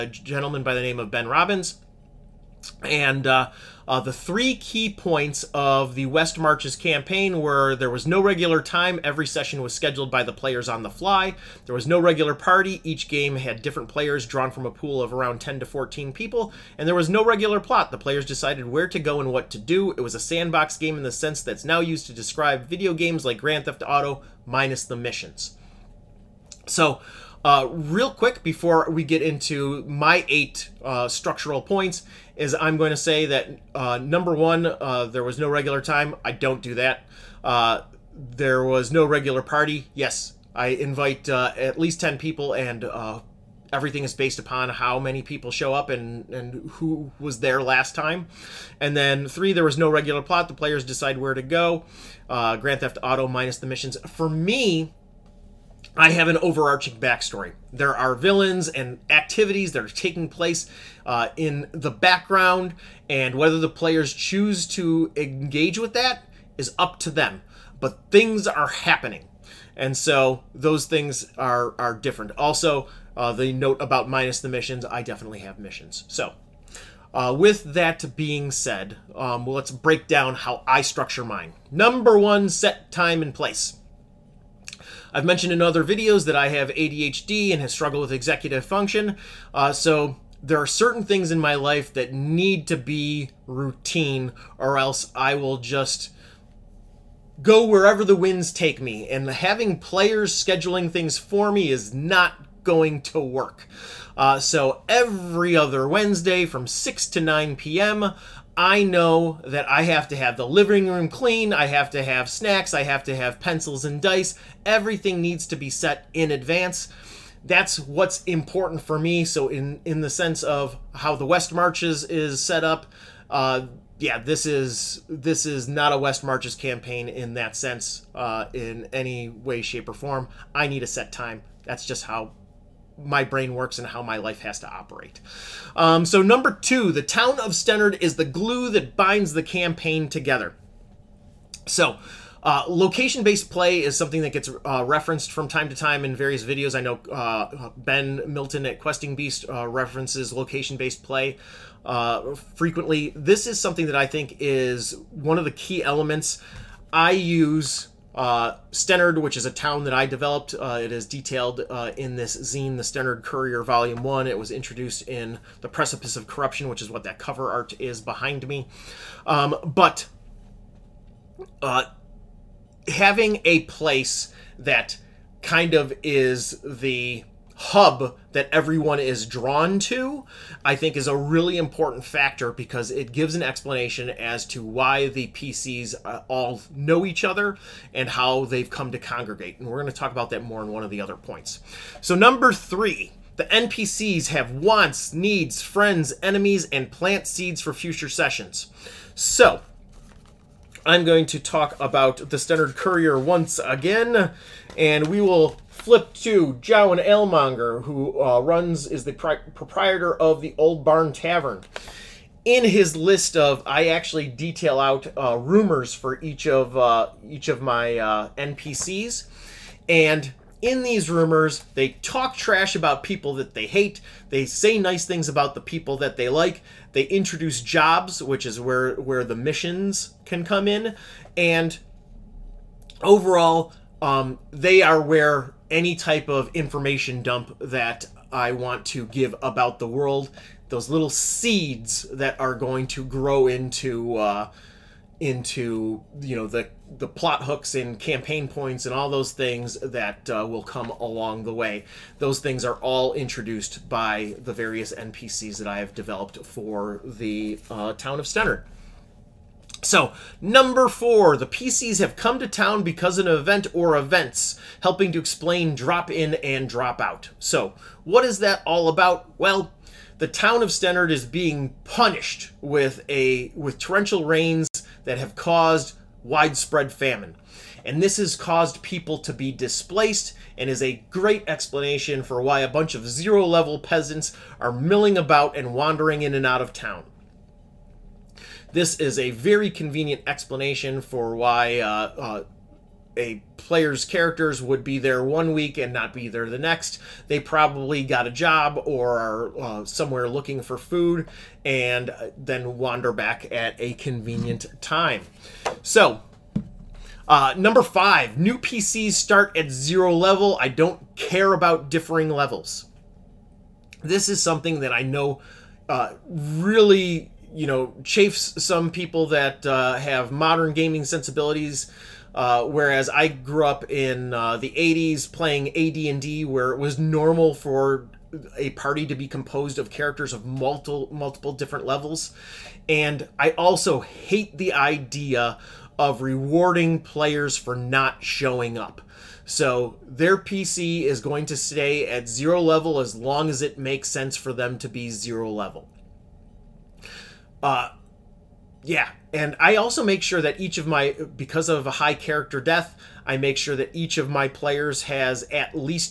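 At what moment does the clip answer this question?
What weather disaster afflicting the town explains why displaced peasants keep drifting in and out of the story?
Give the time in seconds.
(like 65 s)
273 s.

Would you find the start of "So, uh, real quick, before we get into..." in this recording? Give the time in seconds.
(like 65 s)
26 s.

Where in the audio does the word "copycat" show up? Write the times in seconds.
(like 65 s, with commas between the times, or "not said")
not said.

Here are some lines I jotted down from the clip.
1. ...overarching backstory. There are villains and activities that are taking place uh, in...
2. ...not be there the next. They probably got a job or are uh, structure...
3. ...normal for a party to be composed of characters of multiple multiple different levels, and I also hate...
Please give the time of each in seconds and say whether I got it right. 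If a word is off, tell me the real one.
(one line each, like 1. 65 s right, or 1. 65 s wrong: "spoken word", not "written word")
1. 56 s right
2. 295 s wrong: "somewhere", not "structure"
3. 326 s right.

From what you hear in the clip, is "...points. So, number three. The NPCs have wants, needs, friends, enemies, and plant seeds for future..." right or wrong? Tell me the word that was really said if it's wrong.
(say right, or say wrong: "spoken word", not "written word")
right.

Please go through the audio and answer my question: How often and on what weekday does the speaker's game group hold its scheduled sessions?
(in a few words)
Every other Wednesday.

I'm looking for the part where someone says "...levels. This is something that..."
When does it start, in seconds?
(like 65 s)
312 s.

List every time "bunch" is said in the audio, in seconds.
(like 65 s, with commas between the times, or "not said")
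282 s.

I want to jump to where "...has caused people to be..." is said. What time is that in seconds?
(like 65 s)
278 s.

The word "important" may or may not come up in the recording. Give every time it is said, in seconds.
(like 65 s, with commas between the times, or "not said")
118 s, 181 s.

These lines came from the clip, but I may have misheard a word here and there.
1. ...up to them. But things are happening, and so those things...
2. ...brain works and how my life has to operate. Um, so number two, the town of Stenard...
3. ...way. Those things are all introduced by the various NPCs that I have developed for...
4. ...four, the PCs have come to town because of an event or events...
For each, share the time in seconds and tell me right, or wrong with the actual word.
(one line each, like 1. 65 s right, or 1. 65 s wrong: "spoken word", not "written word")
1. 66 s right
2. 133 s right
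3. 251 s right
4. 260 s right.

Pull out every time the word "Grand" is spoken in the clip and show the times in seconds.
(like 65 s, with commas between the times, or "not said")
23 s, 52 s.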